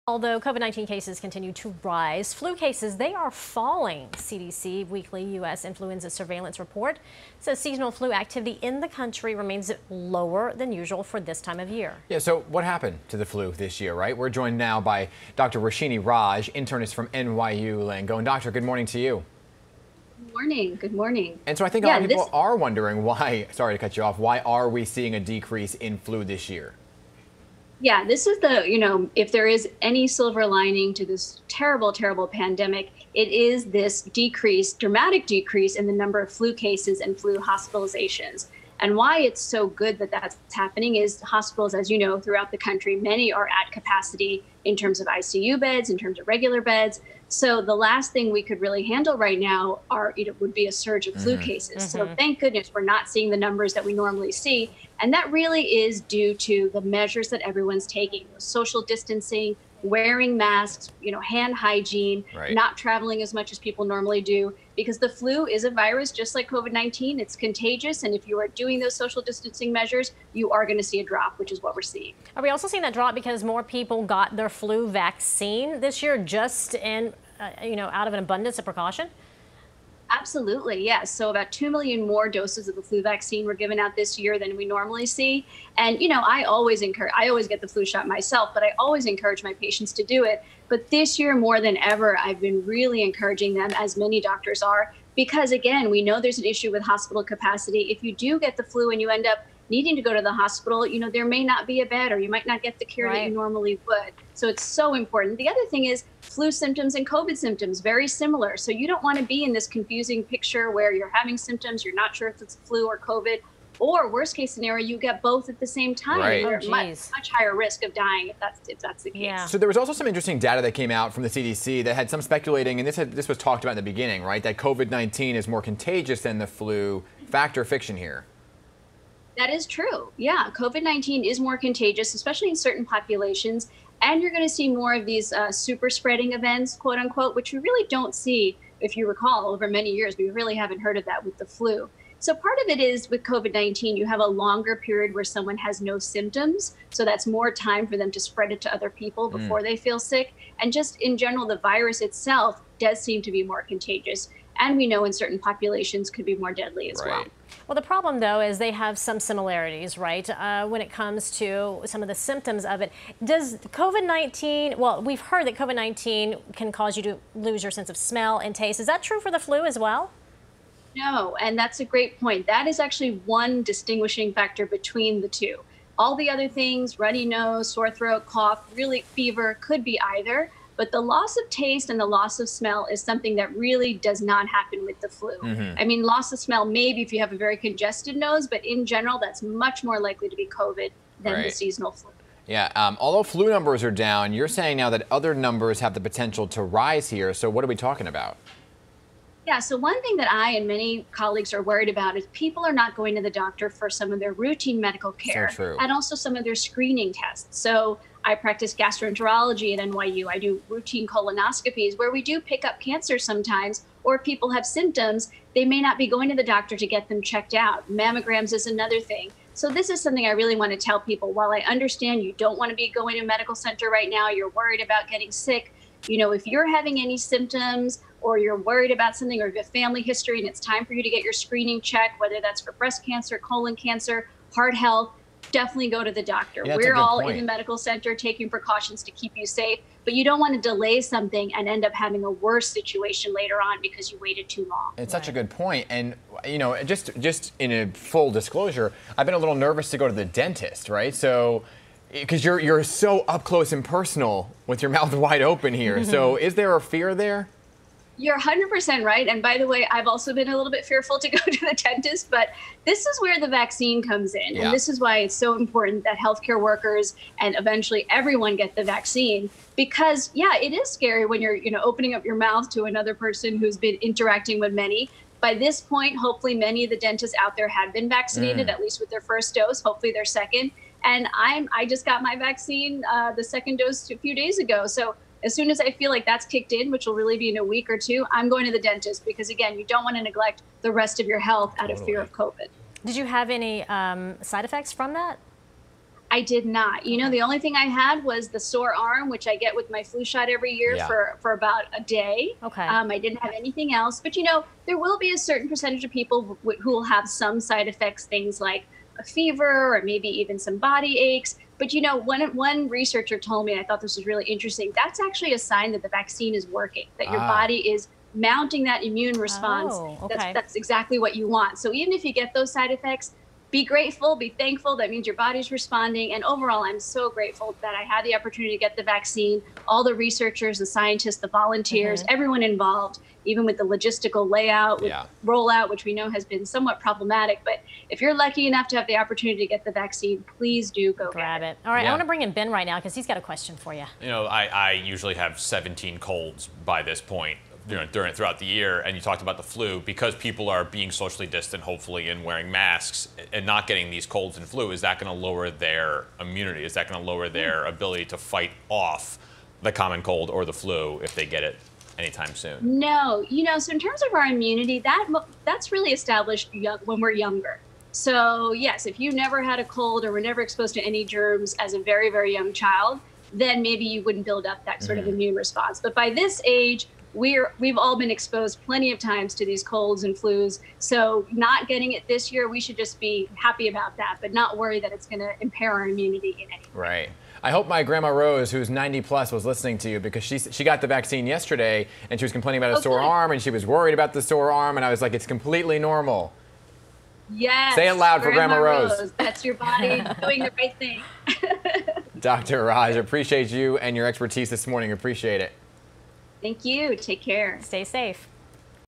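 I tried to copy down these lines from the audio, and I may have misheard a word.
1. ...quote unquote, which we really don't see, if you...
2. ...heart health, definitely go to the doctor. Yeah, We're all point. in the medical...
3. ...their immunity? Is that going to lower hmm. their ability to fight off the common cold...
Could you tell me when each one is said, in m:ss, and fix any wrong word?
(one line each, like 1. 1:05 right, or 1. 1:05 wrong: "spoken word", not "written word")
1. 2:16 right
2. 3:54 right
3. 5:55 right.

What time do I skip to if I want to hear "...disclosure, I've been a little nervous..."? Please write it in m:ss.
4:08.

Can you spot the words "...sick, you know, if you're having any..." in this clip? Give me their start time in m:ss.
3:45.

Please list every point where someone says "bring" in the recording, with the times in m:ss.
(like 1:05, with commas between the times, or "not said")
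5:42.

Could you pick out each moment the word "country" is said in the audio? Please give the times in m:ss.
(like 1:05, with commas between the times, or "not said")
0:08, 0:42.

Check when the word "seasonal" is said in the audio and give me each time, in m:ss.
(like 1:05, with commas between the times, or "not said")
0:07, 3:11.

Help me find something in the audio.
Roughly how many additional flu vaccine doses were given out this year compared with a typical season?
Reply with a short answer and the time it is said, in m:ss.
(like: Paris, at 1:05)
2 million, at 1:21.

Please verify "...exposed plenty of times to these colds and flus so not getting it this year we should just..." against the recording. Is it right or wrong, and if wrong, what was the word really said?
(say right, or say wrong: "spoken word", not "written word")
right.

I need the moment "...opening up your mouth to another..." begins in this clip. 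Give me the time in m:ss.
4:31.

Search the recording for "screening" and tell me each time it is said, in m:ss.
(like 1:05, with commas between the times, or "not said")
3:26, 3:51.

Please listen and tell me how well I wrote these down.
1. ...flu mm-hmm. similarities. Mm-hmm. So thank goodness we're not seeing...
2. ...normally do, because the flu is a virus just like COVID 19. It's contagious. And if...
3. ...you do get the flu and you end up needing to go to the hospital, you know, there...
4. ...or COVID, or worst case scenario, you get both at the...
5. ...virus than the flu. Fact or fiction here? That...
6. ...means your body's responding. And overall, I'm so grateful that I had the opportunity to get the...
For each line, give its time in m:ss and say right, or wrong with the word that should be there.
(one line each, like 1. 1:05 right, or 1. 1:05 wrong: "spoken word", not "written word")
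1. 0:51 wrong: "cases", not "similarities"
2. 1:03 right
3. 1:38 right
4. 1:52 right
5. 2:05 wrong: "contagious", not "virus"
6. 5:25 right.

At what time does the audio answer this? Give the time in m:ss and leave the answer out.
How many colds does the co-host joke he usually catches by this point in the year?
5:45.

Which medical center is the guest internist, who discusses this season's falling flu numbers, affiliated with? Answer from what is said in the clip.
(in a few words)
NYU Langone.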